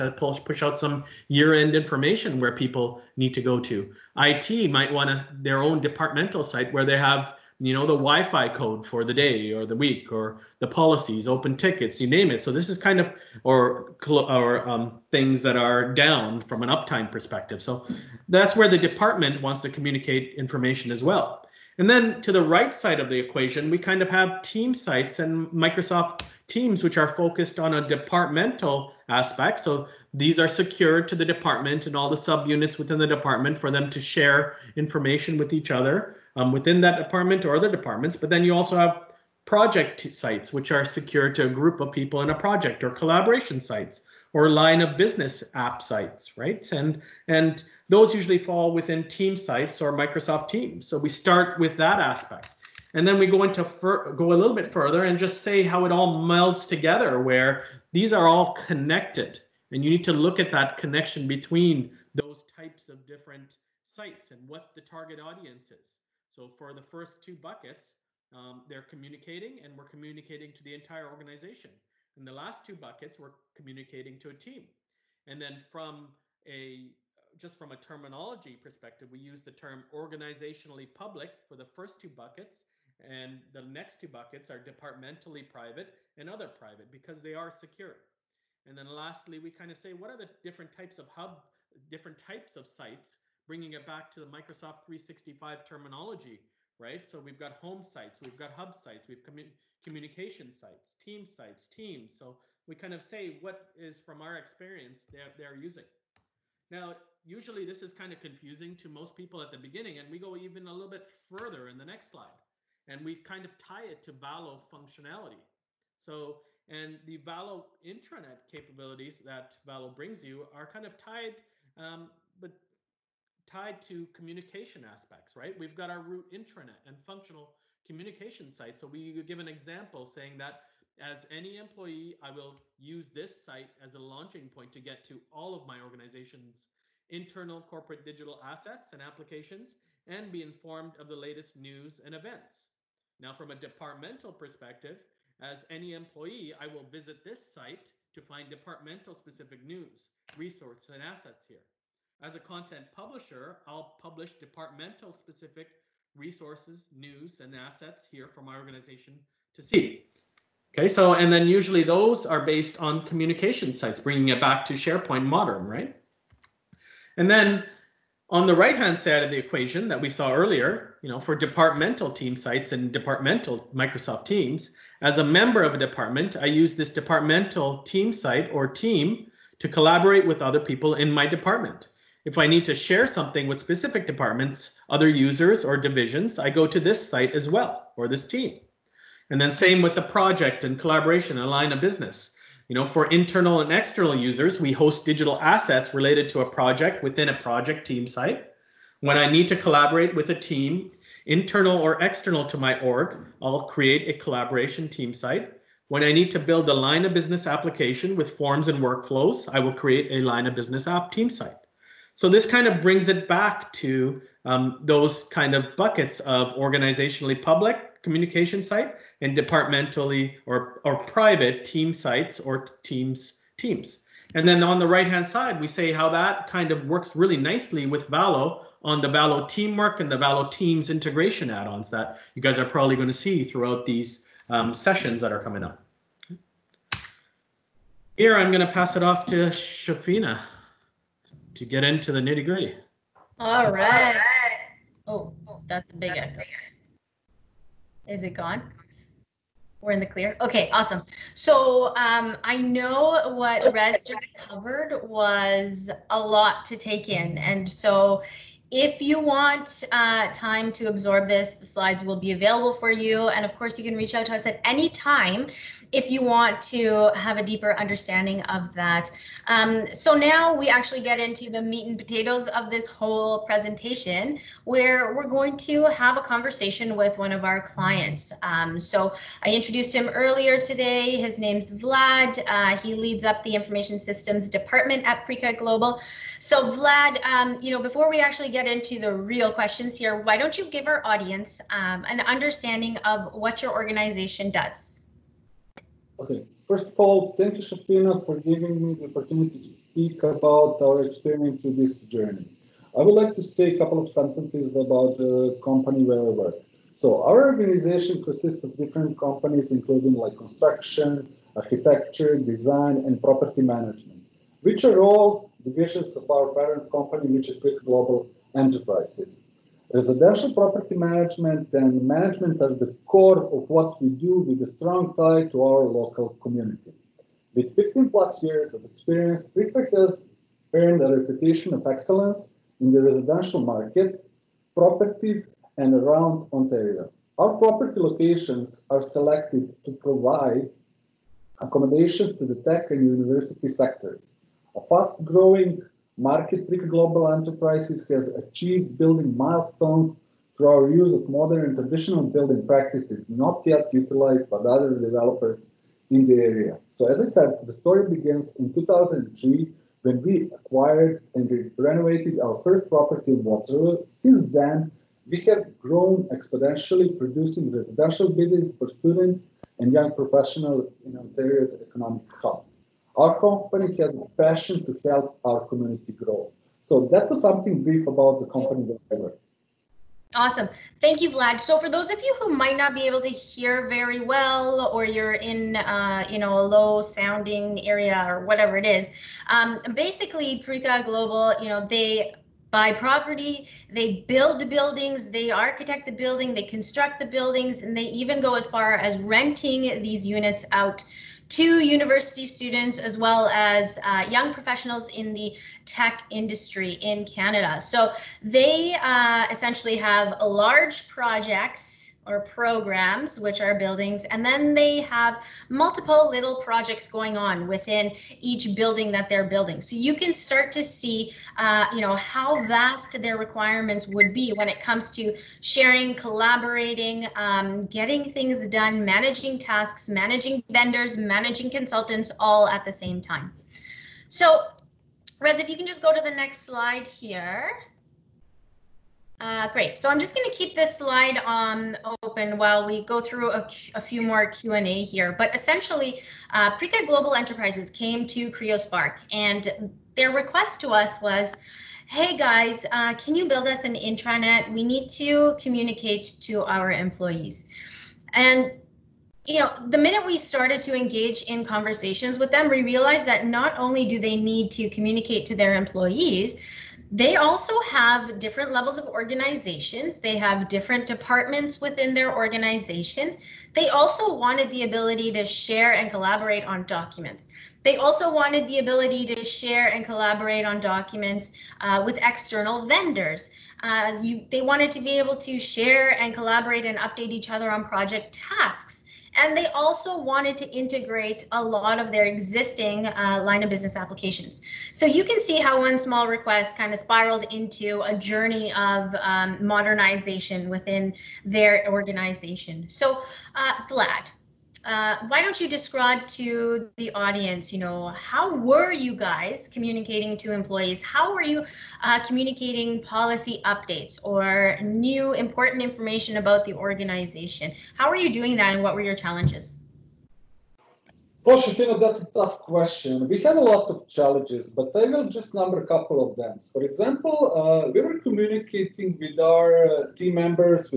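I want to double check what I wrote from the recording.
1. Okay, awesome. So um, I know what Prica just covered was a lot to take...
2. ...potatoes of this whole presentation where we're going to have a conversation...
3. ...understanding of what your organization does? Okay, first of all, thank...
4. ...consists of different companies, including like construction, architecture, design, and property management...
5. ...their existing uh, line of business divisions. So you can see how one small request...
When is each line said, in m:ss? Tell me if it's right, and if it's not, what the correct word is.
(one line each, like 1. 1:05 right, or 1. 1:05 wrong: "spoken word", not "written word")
1. 4:10 wrong: "Res", not "Prica"
2. 4:31 right
3. 4:52 right
4. 5:08 right
5. 8:12 wrong: "applications", not "divisions".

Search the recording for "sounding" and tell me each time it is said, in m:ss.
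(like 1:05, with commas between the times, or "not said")
6:27.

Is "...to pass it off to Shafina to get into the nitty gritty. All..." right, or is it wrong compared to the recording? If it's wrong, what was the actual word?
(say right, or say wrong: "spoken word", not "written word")
right.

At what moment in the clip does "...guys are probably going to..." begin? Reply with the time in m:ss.
3:52.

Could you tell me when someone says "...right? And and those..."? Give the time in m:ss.
0:46.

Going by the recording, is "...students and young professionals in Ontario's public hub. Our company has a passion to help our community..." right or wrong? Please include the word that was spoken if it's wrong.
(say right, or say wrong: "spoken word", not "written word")
wrong: "economic", not "public".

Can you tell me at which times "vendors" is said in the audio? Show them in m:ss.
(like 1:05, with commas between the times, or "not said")
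7:10, 8:02.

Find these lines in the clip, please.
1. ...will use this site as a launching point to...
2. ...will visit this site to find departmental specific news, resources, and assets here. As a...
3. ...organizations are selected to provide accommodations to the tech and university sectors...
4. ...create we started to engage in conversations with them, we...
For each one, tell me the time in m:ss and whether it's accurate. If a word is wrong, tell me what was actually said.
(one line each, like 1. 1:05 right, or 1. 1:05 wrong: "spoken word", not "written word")
1. 2:12 right
2. 2:26 right
3. 5:38 wrong: "locations", not "organizations"
4. 7:39 wrong: "minute", not "create".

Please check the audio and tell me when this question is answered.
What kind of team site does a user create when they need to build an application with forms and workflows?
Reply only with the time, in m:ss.
3:30.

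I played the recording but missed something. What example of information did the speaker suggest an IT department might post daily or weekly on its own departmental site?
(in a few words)
Wi-fi code.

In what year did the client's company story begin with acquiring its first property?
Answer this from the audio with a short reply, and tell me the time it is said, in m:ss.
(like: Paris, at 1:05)
2003, at 5:58.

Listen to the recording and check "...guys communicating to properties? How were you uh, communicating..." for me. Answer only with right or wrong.
wrong.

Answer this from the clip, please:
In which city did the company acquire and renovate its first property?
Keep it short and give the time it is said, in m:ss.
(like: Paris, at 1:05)
Waterloo, at 6:03.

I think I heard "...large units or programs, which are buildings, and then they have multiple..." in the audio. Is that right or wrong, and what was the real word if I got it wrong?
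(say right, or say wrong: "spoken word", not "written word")
wrong: "projects", not "units".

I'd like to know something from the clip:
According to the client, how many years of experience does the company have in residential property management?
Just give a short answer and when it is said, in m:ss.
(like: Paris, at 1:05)
15 plus years, at 5:27.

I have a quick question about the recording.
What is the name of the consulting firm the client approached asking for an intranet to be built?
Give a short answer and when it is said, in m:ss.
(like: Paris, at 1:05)
CreoSpark, at 7:28.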